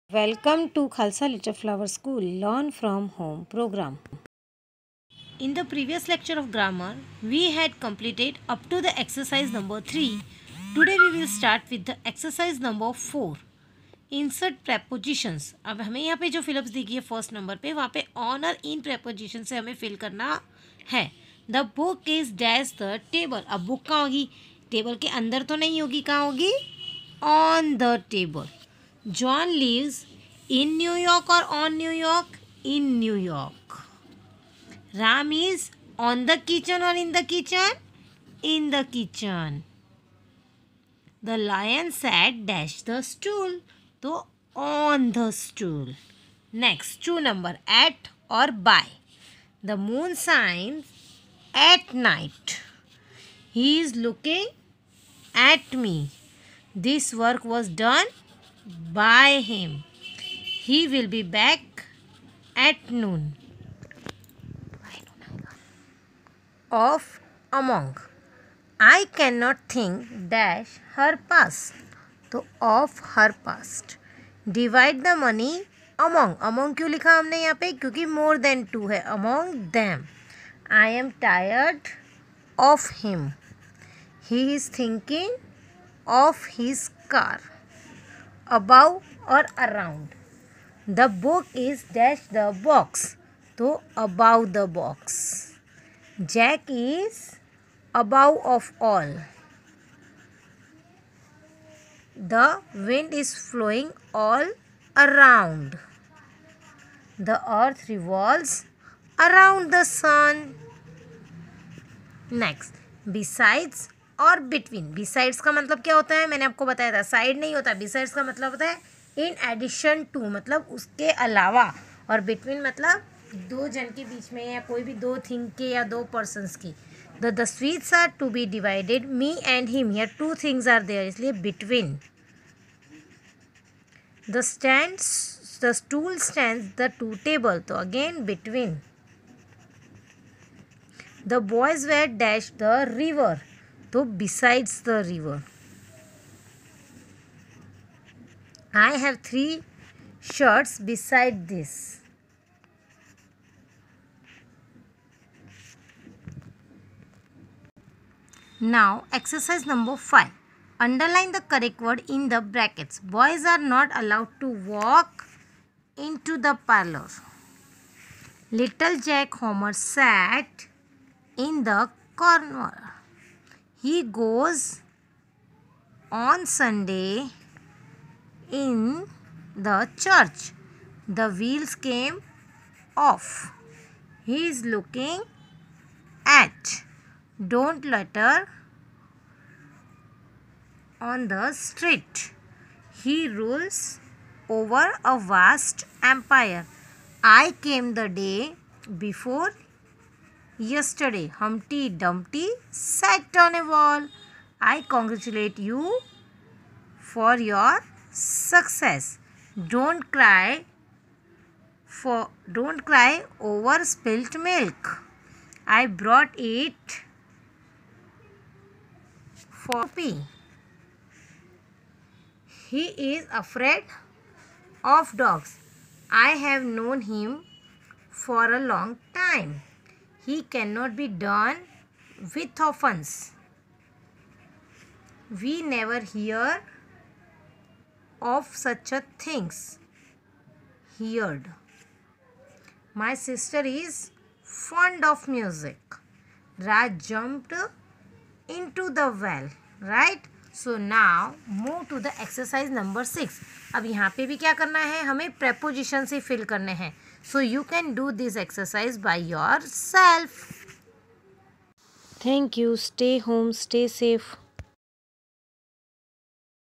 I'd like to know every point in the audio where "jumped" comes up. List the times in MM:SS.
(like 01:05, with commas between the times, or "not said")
04:07.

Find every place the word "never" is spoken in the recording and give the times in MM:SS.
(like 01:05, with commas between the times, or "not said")
03:55.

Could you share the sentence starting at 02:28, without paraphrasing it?
I have three shirts beside this.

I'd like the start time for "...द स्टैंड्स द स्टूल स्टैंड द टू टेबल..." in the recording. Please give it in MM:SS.
02:14.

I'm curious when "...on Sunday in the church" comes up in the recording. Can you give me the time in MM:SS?
02:56.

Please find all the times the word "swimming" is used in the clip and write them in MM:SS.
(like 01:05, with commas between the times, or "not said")
not said.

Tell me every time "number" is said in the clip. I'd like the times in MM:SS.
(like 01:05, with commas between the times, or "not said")
00:47, 02:39, 04:12.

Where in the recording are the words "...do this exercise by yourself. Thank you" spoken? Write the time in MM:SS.
04:17.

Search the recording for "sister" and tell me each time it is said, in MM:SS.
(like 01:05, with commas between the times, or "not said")
04:03.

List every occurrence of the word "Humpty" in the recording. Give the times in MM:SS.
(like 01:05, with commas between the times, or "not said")
03:21.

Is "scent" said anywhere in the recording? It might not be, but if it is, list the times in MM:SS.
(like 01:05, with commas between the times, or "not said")
not said.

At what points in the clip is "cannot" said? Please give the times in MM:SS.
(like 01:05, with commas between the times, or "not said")
01:09, 03:50.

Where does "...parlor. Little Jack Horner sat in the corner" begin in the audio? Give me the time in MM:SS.
02:46.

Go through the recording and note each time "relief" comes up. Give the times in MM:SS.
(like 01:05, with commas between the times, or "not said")
not said.